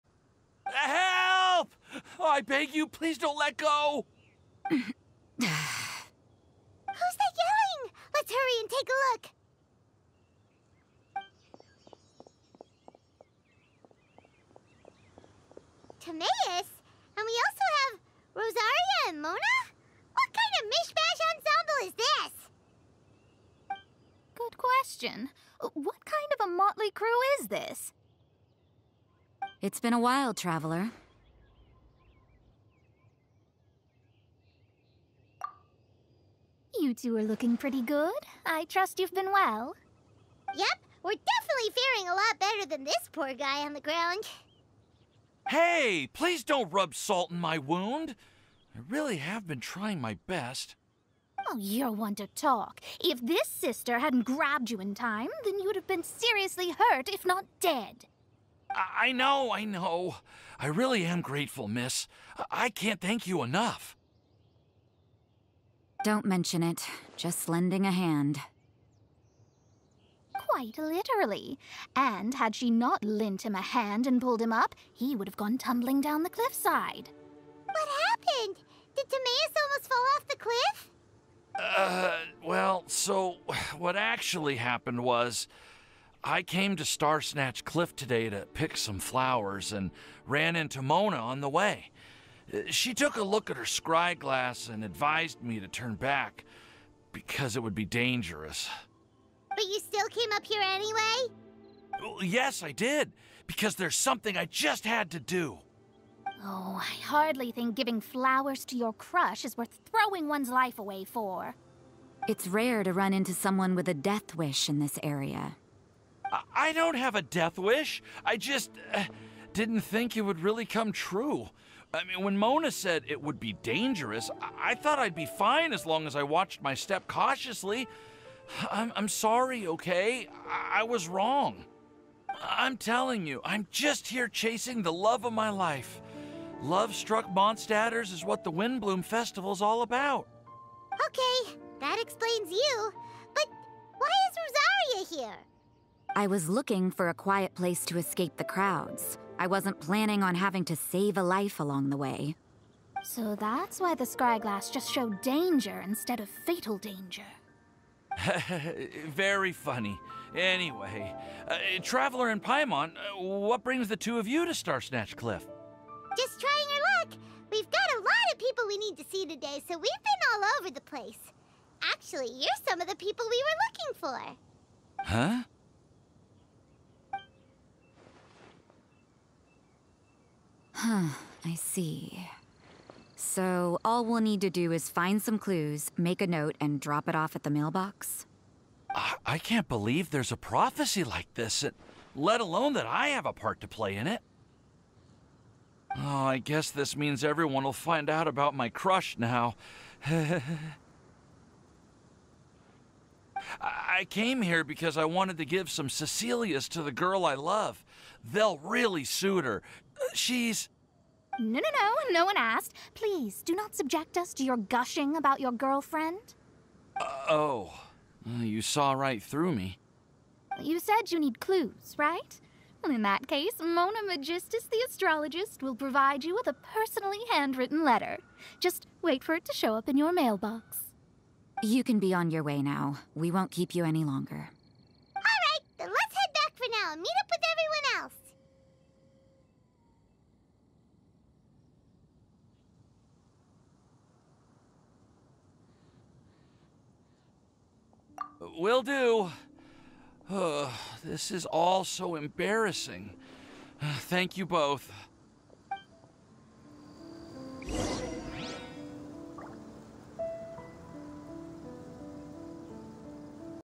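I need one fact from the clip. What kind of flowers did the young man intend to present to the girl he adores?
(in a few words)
Cecilias.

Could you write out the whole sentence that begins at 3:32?
Please, do not subject us to your gushing about your girlfriend.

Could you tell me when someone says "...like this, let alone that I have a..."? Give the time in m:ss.
3:11.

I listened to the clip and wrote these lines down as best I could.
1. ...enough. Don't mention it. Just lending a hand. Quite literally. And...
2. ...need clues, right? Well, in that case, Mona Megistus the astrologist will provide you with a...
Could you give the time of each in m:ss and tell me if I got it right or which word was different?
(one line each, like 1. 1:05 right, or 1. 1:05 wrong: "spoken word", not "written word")
1. 1:03 right
2. 3:41 right.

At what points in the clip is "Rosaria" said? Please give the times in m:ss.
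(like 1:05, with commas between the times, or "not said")
0:18, 2:25.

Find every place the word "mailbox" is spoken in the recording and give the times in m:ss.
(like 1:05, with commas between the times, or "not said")
3:07, 3:50.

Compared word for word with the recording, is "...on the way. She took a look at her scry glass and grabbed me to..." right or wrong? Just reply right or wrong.
wrong.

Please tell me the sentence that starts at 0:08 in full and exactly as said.
Let's hurry and take a look.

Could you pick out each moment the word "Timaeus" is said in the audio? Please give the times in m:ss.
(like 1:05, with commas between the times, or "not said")
0:15, 1:19.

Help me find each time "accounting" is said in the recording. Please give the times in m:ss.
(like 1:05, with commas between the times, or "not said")
not said.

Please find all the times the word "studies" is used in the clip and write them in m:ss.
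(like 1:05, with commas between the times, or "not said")
not said.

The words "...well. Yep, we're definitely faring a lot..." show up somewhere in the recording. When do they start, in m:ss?
0:39.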